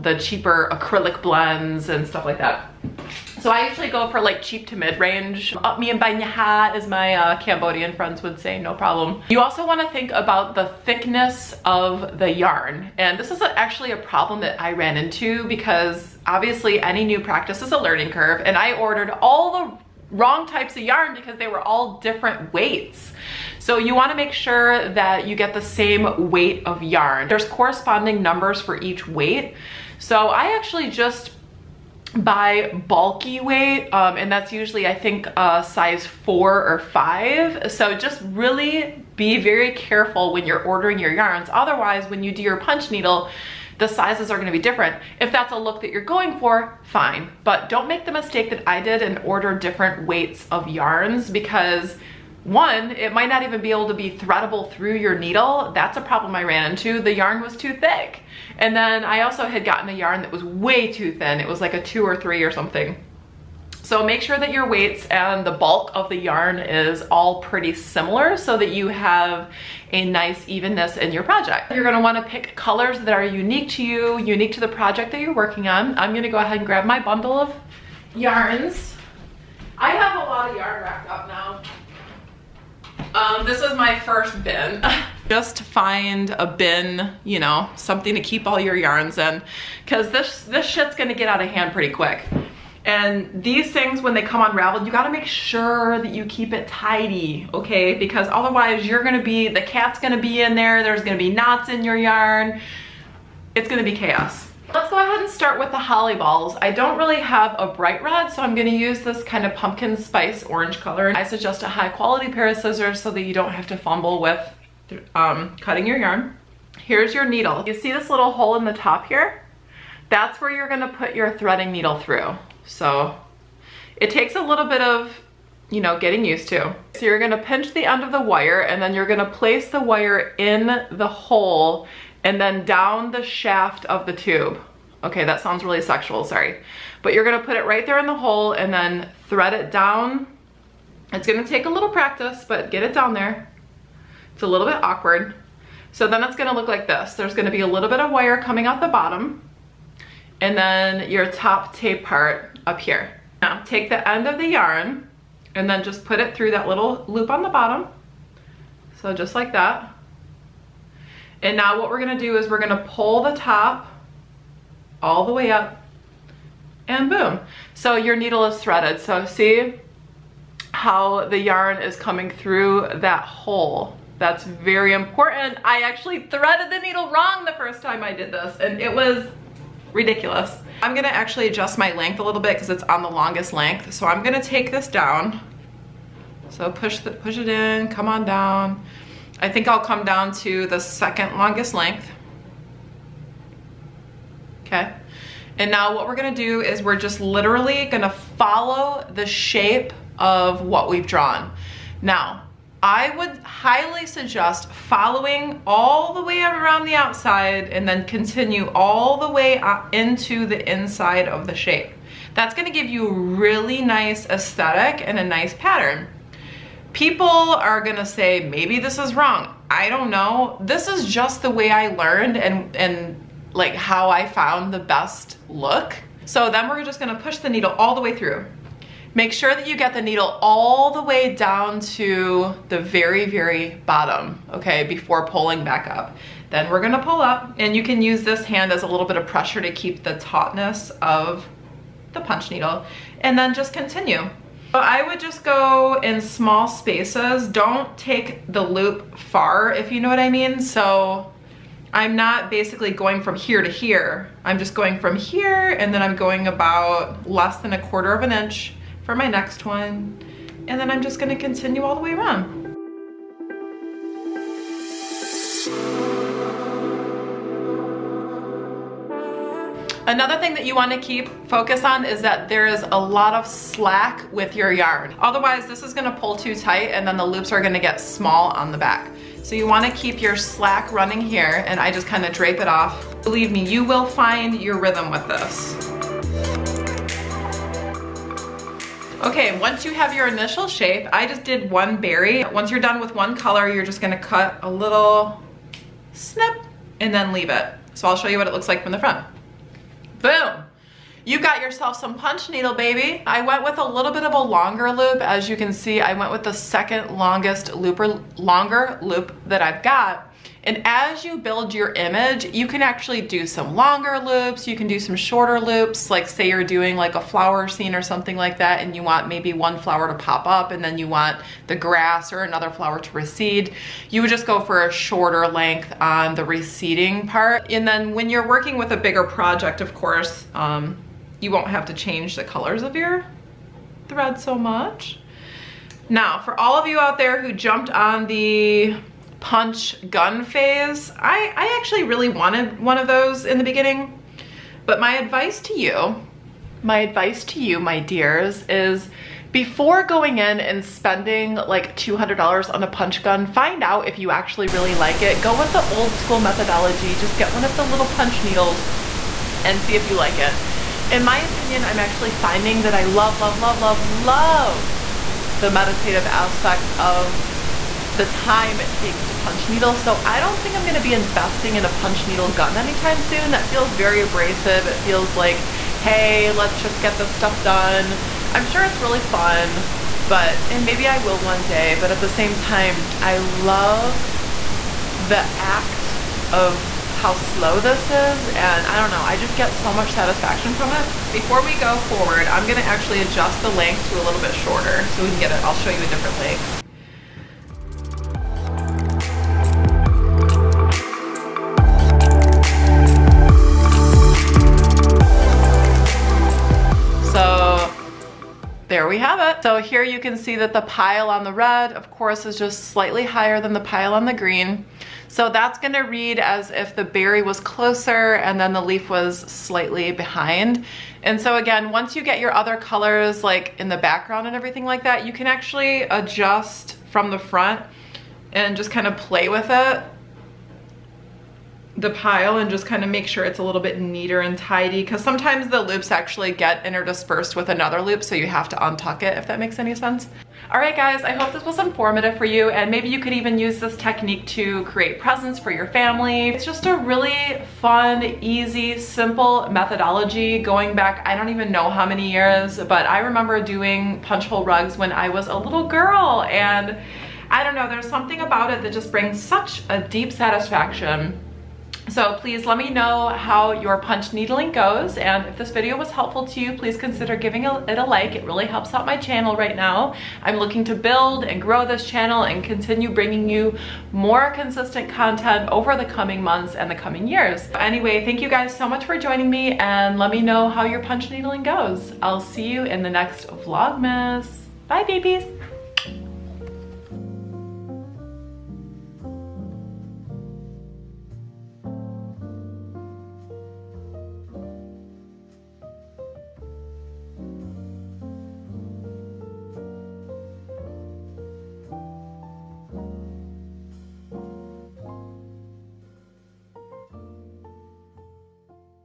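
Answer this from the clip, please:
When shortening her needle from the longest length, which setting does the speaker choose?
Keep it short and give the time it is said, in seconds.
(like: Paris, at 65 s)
second longest length, at 190 s.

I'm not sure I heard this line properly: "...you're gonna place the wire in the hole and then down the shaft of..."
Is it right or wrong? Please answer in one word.
right.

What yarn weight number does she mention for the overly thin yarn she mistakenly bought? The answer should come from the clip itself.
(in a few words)
2 or 3.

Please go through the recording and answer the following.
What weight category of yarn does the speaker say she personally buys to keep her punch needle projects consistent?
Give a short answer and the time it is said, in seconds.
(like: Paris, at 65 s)
bulky weight, at 32 s.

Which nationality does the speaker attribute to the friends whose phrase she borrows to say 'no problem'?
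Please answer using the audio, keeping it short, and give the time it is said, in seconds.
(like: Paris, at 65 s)
Cambodian, at 7 s.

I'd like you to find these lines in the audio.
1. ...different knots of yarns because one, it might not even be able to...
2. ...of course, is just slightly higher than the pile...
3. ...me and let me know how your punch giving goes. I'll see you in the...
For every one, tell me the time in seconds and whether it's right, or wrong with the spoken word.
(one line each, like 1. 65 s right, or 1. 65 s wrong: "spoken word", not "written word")
1. 49 s wrong: "weights", not "knots"
2. 411 s right
3. 479 s wrong: "needling", not "giving".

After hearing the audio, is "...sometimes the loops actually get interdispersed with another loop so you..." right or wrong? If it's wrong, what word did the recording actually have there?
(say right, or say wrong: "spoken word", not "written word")
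right.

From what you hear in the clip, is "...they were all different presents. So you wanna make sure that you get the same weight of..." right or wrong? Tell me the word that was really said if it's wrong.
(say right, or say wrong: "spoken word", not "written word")
wrong: "weights", not "presents".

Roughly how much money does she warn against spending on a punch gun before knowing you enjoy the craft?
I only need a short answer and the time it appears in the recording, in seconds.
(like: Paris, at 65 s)
$200, at 351 s.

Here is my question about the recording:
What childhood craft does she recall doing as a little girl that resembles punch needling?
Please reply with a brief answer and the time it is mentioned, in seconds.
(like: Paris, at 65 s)
punch hole rugs, at 454 s.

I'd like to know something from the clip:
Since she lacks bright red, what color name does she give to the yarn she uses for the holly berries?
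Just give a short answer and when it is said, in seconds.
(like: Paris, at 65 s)
pumpkin spice orange, at 109 s.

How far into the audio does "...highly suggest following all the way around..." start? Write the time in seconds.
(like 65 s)
203 s.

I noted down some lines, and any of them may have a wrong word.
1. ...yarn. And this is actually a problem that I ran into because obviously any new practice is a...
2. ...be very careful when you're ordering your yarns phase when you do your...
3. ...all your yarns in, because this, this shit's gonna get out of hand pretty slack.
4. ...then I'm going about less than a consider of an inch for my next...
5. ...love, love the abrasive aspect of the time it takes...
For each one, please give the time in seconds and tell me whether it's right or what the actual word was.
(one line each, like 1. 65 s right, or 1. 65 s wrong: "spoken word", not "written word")
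1. 12 s right
2. 39 s wrong: "otherwise", not "phase"
3. 88 s wrong: "quick", not "slack"
4. 255 s wrong: "quarter", not "consider"
5. 363 s wrong: "meditative", not "abrasive".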